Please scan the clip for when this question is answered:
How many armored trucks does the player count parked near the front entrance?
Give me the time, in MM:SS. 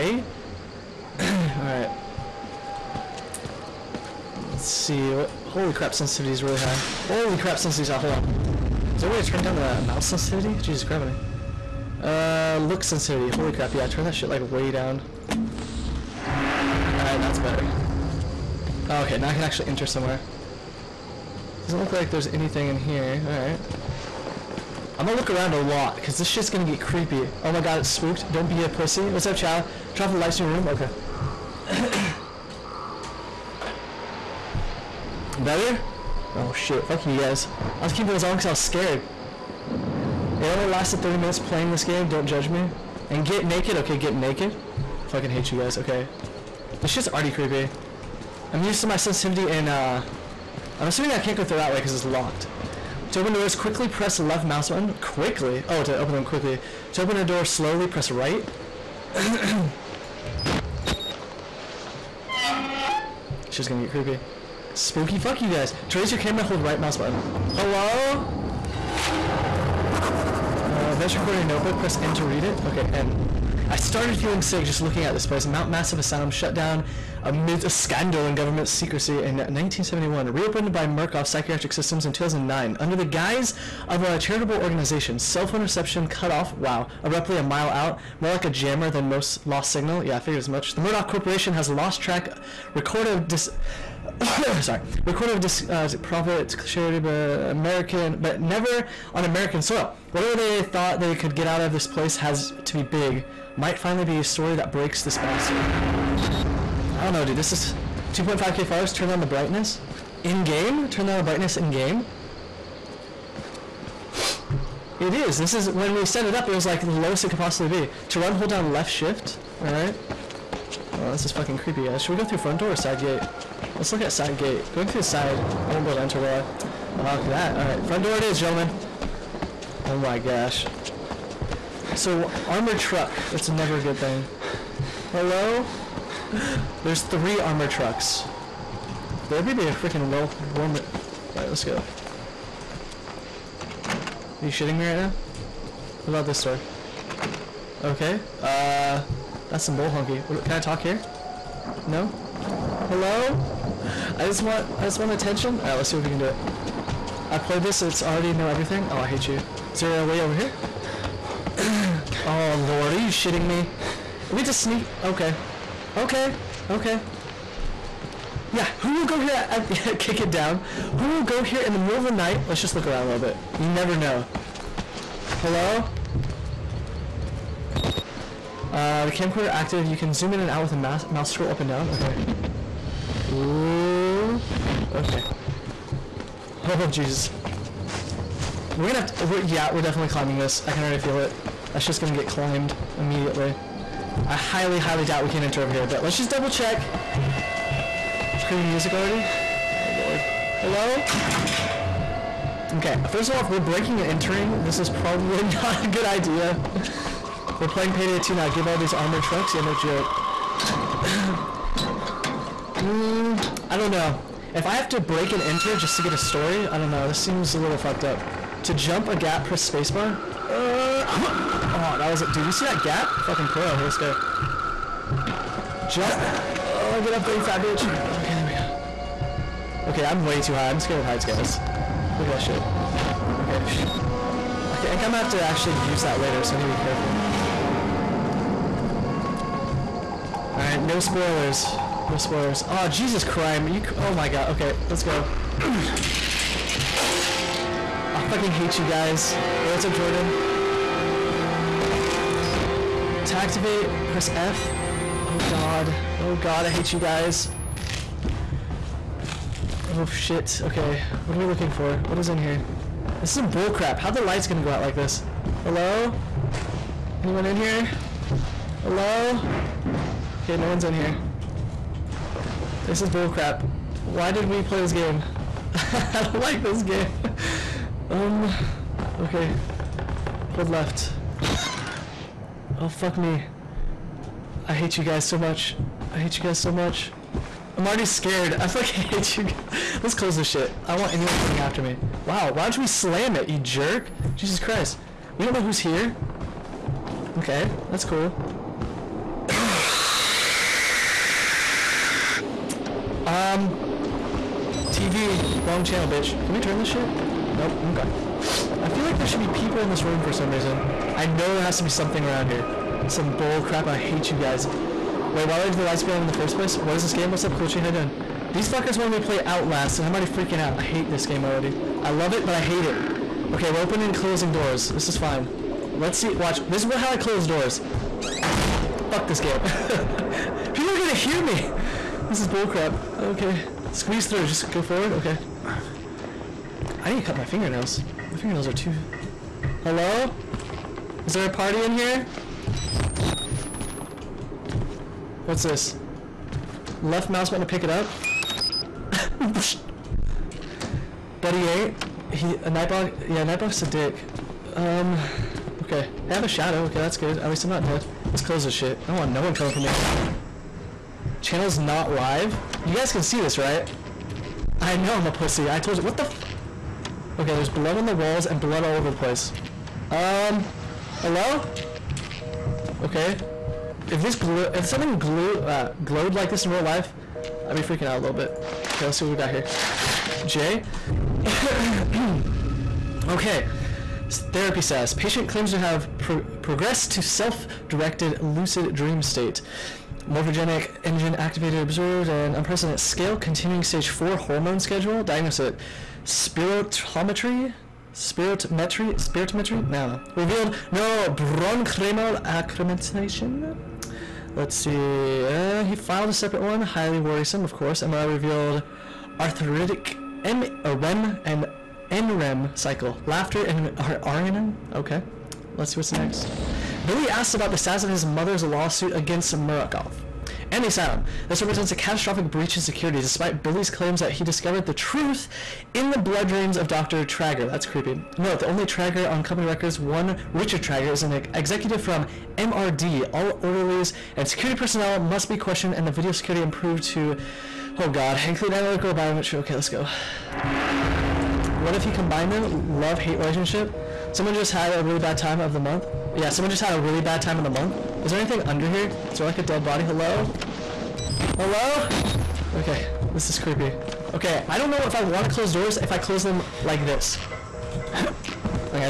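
02:17.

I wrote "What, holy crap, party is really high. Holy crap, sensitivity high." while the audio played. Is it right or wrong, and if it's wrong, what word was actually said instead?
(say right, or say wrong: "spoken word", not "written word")
wrong: "sensitivity", not "party".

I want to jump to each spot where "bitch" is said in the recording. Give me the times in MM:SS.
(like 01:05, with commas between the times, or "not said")
03:47, 05:06.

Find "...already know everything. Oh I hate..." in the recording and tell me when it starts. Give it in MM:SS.
02:38.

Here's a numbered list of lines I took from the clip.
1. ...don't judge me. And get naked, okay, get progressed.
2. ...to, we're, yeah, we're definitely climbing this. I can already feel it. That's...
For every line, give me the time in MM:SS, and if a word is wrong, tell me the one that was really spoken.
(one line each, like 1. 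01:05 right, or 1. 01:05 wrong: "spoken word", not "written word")
1. 00:42 wrong: "naked", not "progressed"
2. 03:09 right.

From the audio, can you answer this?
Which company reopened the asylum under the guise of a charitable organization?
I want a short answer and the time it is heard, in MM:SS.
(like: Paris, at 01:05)
Murkoff Psychiatric Systems, at 01:20.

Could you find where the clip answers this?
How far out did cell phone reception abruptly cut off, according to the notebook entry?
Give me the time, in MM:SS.
01:27.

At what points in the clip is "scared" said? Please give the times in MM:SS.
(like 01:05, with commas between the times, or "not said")
00:38, 03:50, 04:48.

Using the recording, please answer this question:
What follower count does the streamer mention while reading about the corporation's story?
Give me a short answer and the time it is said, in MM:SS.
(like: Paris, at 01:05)
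2.5k, at 01:48.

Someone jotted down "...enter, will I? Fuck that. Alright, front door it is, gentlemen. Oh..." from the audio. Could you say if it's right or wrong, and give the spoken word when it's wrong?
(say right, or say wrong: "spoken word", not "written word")
right.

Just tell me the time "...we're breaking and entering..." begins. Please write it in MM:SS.
03:23.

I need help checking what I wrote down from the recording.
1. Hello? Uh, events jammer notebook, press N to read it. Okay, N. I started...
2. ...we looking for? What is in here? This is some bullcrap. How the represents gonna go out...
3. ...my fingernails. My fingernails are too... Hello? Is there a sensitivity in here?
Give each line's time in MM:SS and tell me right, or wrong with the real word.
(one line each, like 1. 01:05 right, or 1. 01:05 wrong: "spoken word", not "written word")
1. 01:07 wrong: "recorder", not "jammer"
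2. 04:21 wrong: "lights", not "represents"
3. 05:37 wrong: "party", not "sensitivity".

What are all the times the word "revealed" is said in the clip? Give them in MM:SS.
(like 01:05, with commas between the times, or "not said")
06:40, 06:48.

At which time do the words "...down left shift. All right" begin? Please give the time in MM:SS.
01:58.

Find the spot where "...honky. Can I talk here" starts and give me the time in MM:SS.
02:29.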